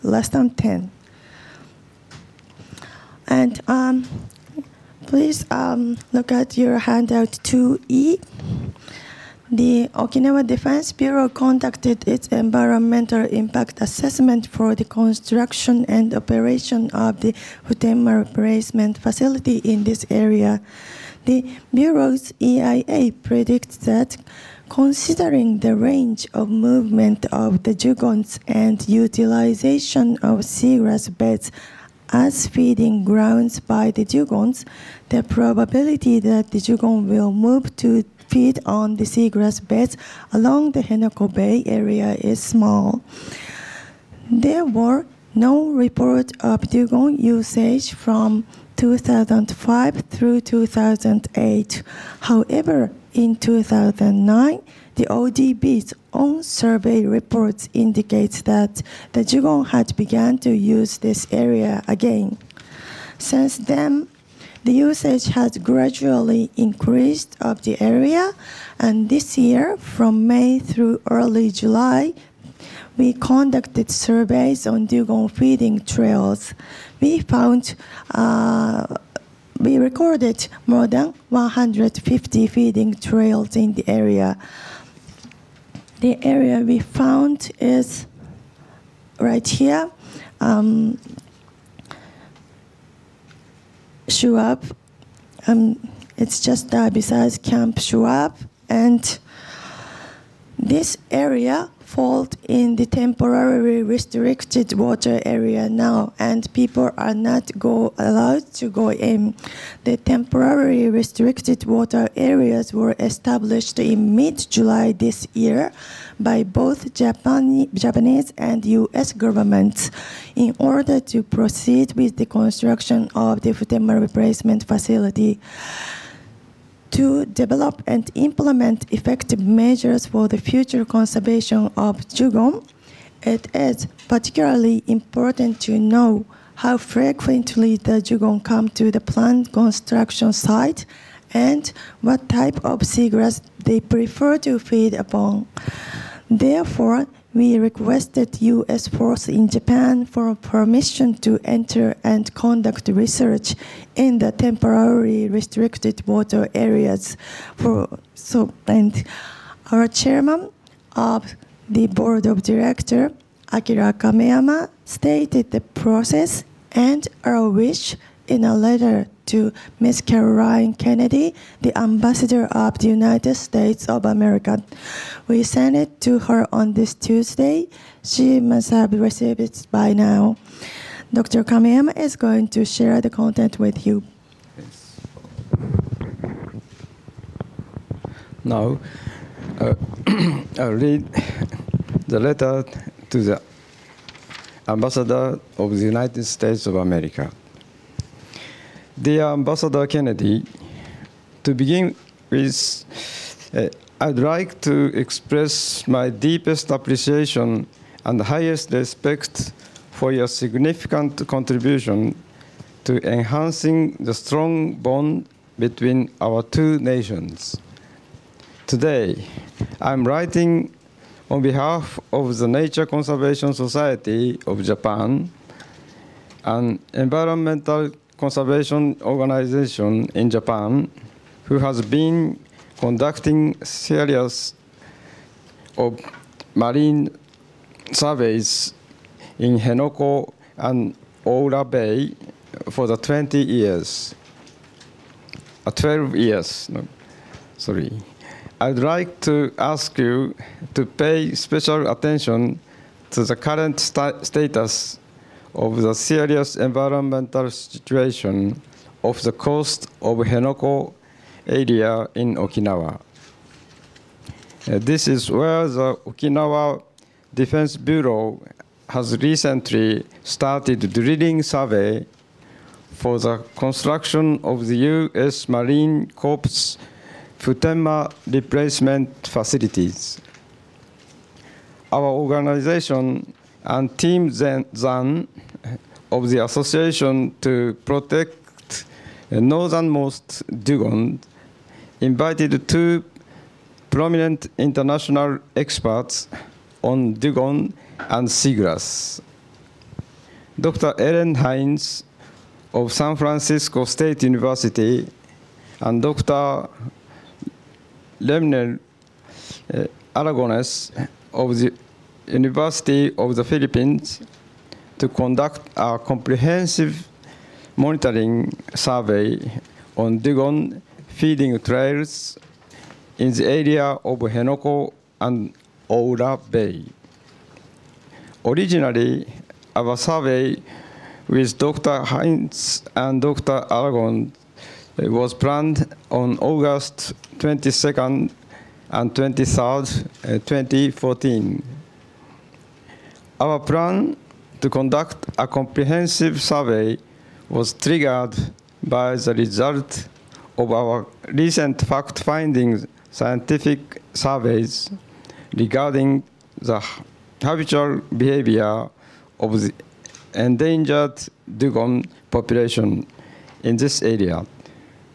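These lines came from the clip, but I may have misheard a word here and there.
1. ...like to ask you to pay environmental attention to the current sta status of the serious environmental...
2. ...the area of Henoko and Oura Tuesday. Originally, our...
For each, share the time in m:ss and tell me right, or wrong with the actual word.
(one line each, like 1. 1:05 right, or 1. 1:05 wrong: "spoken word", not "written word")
1. 4:08 wrong: "special", not "environmental"
2. 5:23 wrong: "Bay", not "Tuesday".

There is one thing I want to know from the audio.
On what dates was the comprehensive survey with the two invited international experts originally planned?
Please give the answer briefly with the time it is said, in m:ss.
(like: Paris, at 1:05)
August 22 and 23, 2014, at 5:36.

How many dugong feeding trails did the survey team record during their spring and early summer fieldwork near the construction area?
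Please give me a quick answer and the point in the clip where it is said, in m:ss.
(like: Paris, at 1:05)
More than 150, at 1:20.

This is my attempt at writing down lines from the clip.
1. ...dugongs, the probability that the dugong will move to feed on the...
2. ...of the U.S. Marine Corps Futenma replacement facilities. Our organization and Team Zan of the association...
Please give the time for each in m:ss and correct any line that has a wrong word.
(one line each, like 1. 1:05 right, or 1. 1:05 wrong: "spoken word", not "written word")
1. 0:34 right
2. 4:34 right.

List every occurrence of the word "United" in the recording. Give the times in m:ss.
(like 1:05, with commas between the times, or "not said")
2:52, 3:15.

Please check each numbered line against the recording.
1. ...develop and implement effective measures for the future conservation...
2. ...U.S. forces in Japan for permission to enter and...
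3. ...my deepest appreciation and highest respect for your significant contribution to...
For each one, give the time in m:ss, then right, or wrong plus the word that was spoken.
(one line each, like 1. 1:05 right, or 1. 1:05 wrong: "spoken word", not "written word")
1. 2:07 right
2. 2:28 right
3. 3:25 right.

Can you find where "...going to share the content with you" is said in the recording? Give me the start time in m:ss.
3:02.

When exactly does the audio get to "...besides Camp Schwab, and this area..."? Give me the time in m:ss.
1:36.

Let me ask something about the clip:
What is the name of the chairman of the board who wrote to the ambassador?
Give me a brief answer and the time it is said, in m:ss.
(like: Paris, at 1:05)
Akira Kameyama, at 2:43.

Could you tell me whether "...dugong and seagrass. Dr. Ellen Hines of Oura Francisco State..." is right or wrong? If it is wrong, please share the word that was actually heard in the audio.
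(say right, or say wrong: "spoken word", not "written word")
wrong: "San", not "Oura".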